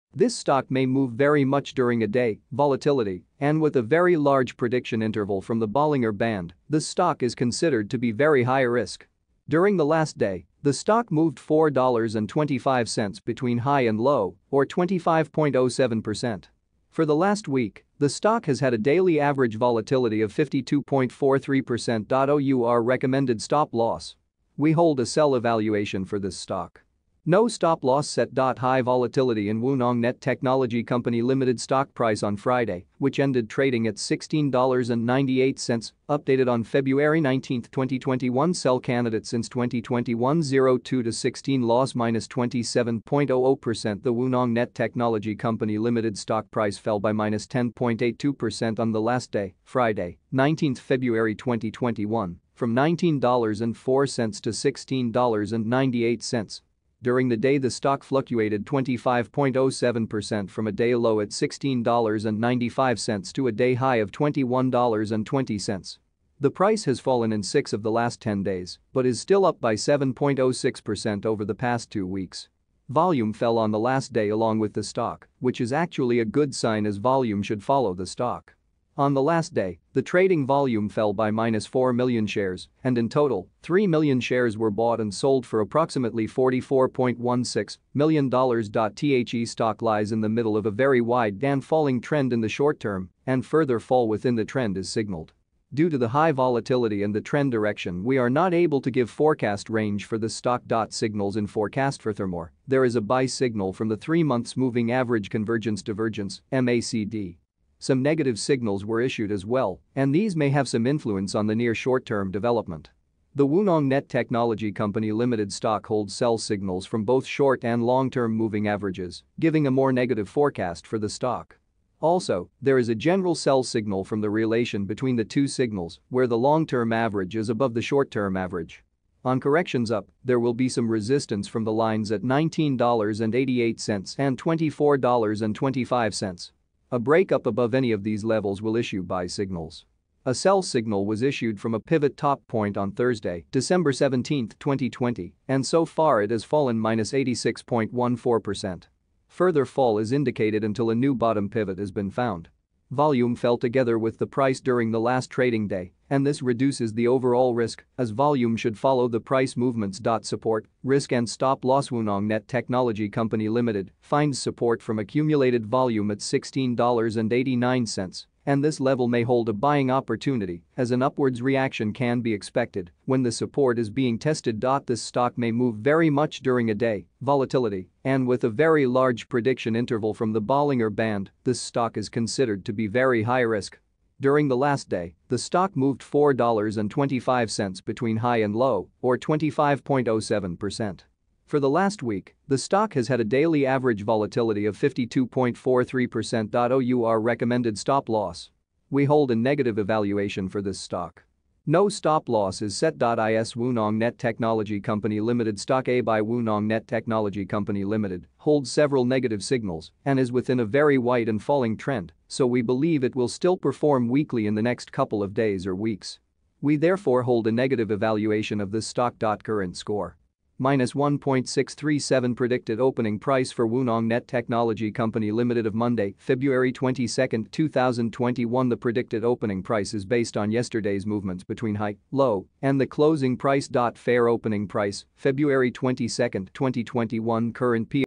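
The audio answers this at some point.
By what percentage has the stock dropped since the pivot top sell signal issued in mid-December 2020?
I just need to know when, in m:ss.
2:27.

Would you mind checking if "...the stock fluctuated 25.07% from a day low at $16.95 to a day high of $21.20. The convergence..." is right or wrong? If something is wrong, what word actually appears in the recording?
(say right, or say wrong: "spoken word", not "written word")
wrong: "price", not "convergence".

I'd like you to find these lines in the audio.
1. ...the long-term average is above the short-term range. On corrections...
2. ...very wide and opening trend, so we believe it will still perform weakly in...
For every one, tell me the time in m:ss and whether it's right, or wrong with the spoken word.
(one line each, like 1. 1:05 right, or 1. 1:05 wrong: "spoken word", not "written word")
1. 2:06 wrong: "average", not "range"
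2. 3:30 wrong: "falling", not "opening".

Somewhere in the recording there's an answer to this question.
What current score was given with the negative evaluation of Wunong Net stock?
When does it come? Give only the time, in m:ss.
3:40.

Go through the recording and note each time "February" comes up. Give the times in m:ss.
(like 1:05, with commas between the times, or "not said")
0:36, 0:50, 3:46, 3:55.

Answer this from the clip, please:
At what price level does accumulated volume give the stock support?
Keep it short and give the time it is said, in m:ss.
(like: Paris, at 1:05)
$16.89, at 2:46.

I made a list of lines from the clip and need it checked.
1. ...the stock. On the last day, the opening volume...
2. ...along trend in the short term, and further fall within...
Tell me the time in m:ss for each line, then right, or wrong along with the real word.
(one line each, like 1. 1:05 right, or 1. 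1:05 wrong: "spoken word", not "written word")
1. 1:17 wrong: "trading", not "opening"
2. 1:31 wrong: "falling", not "along".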